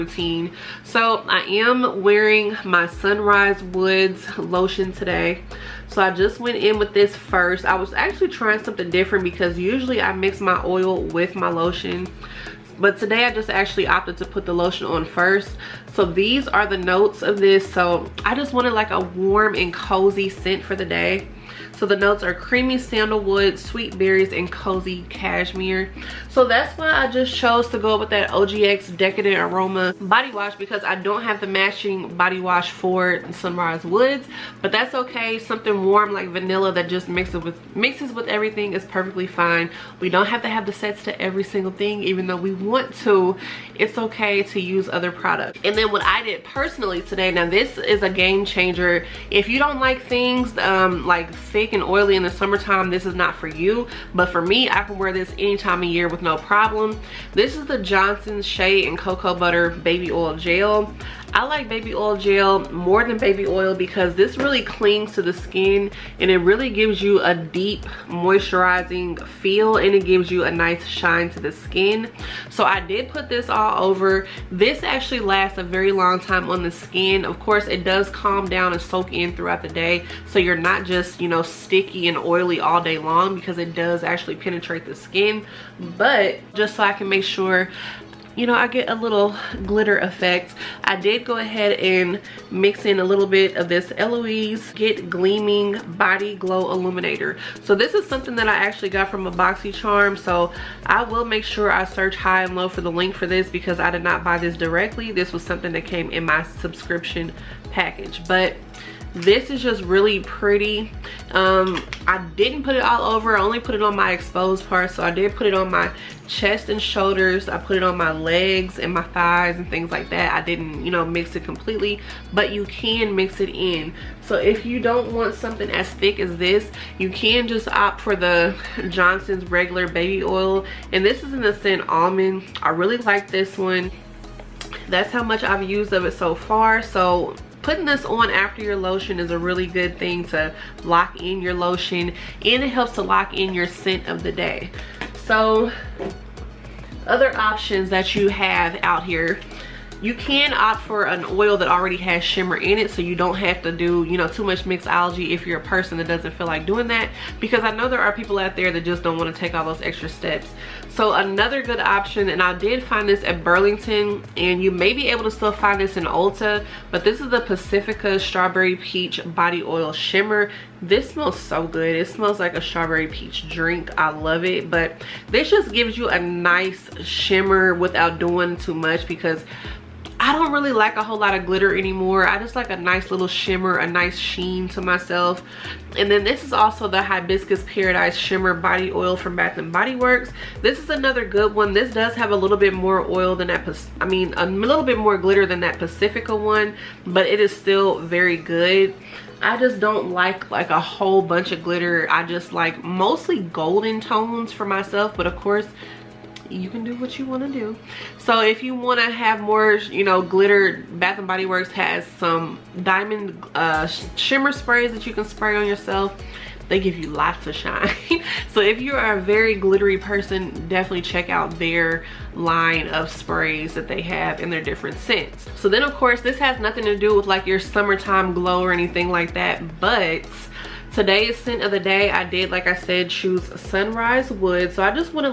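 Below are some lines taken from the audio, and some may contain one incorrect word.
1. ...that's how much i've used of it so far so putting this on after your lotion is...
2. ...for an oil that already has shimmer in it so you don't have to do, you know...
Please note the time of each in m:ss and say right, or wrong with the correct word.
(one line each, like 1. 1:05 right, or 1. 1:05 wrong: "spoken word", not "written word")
1. 2:14 right
2. 2:30 right.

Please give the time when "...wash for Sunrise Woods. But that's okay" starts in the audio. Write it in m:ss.
0:32.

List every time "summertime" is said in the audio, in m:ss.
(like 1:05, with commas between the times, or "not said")
0:52, 3:47.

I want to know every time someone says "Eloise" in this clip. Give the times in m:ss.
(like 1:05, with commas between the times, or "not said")
1:33.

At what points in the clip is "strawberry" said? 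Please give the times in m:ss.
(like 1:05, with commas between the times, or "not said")
2:48, 2:52.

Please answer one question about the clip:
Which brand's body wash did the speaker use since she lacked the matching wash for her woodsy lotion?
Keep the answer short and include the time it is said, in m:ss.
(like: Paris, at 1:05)
OGX, at 0:28.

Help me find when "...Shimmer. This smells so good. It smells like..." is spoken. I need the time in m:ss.
2:49.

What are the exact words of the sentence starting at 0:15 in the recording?
So these are the notes of this.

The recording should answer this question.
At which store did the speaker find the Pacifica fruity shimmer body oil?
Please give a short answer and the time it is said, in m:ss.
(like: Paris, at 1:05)
Burlington, at 2:43.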